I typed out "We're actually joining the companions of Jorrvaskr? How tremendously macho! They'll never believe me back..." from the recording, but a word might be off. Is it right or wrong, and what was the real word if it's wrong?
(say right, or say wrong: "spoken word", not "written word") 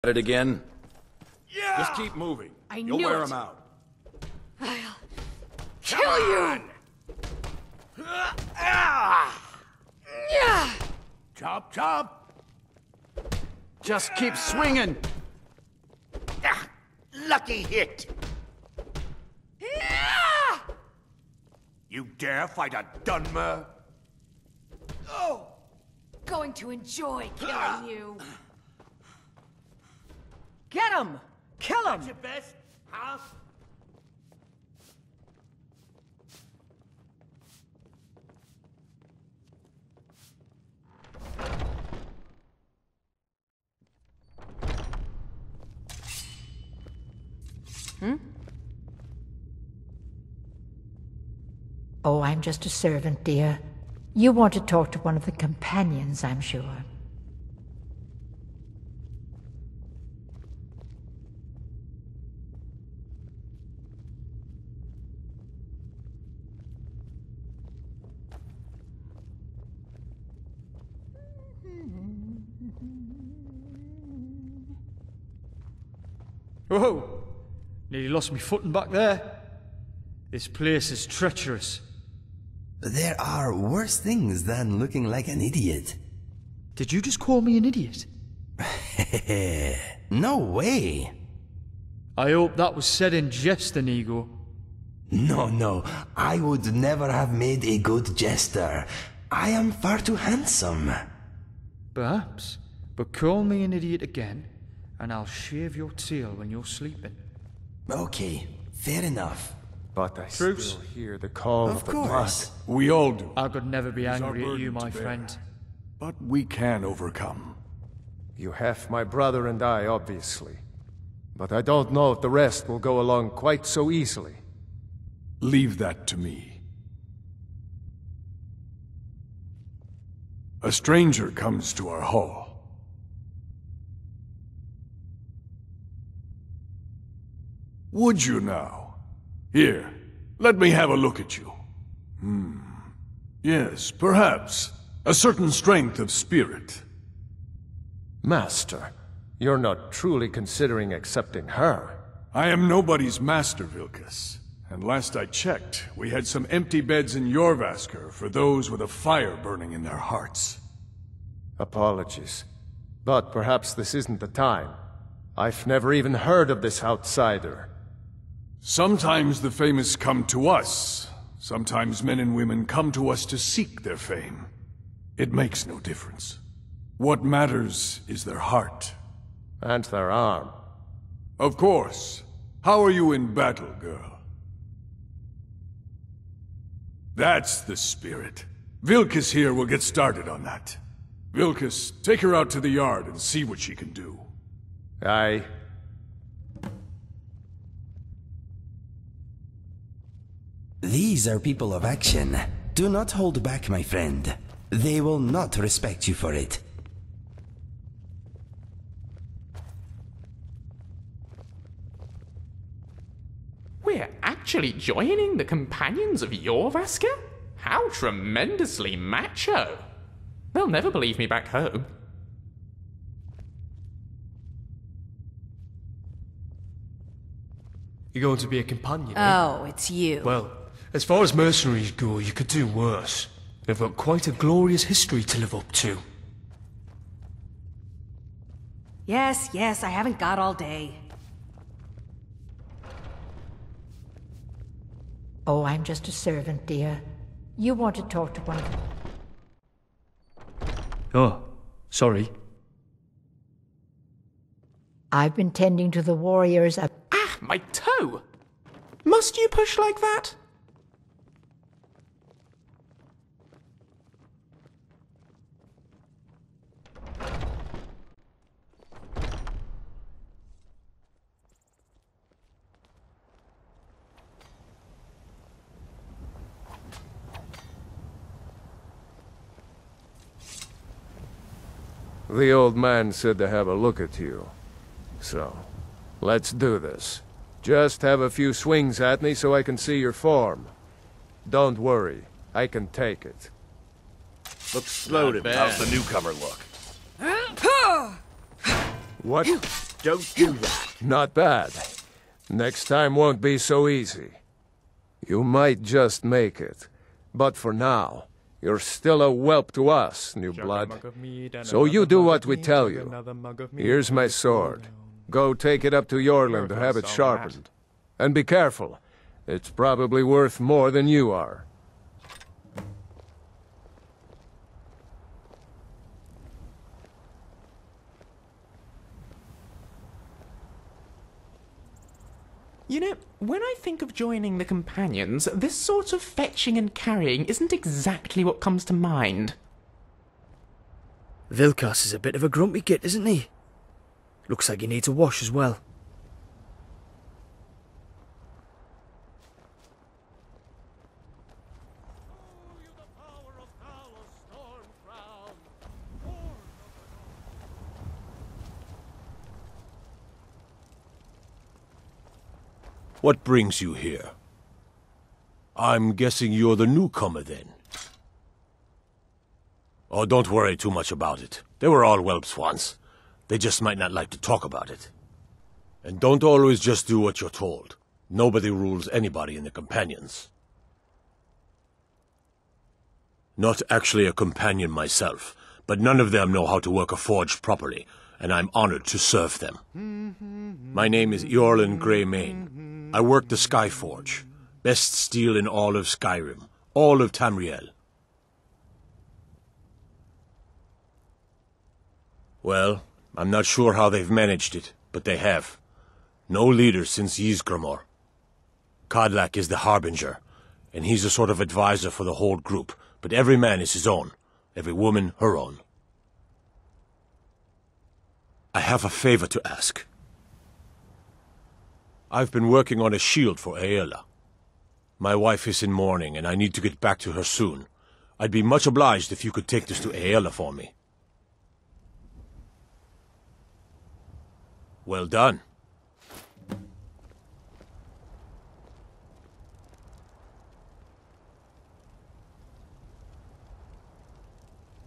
right.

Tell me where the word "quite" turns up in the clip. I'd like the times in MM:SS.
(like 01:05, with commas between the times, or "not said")
02:03, 03:53.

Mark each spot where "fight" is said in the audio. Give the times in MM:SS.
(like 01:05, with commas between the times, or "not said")
00:22.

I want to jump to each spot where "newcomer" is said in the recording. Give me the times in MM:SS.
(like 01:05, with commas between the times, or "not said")
04:55, 06:06.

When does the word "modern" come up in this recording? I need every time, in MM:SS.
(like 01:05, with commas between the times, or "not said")
not said.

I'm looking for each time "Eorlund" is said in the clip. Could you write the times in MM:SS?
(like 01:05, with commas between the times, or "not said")
05:16, 06:31.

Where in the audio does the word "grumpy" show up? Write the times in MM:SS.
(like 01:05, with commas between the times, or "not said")
05:42.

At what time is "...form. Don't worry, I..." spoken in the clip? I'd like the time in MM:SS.
04:50.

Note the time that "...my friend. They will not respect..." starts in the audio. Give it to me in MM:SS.
03:23.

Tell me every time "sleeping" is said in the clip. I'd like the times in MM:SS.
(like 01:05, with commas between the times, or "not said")
01:46.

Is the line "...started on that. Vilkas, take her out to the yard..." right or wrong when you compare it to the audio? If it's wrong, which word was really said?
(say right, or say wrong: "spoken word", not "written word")
right.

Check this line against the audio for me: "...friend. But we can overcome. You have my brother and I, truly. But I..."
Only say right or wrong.
wrong.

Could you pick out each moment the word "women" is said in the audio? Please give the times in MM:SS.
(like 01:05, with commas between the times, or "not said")
02:52.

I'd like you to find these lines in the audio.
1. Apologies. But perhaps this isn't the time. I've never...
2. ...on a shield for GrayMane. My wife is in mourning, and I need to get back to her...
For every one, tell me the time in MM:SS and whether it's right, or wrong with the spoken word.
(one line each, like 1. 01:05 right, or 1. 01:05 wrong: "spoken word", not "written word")
1. 02:41 right
2. 07:03 wrong: "Aela", not "GrayMane".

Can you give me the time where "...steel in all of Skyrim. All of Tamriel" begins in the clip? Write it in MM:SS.
06:35.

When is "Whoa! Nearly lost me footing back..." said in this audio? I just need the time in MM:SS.
01:16.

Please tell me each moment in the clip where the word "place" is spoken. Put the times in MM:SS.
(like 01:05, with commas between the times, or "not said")
01:20.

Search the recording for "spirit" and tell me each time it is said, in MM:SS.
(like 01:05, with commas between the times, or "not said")
02:26, 03:07.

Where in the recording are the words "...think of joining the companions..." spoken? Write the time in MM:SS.
05:33.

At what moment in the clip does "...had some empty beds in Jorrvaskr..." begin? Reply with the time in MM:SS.
02:36.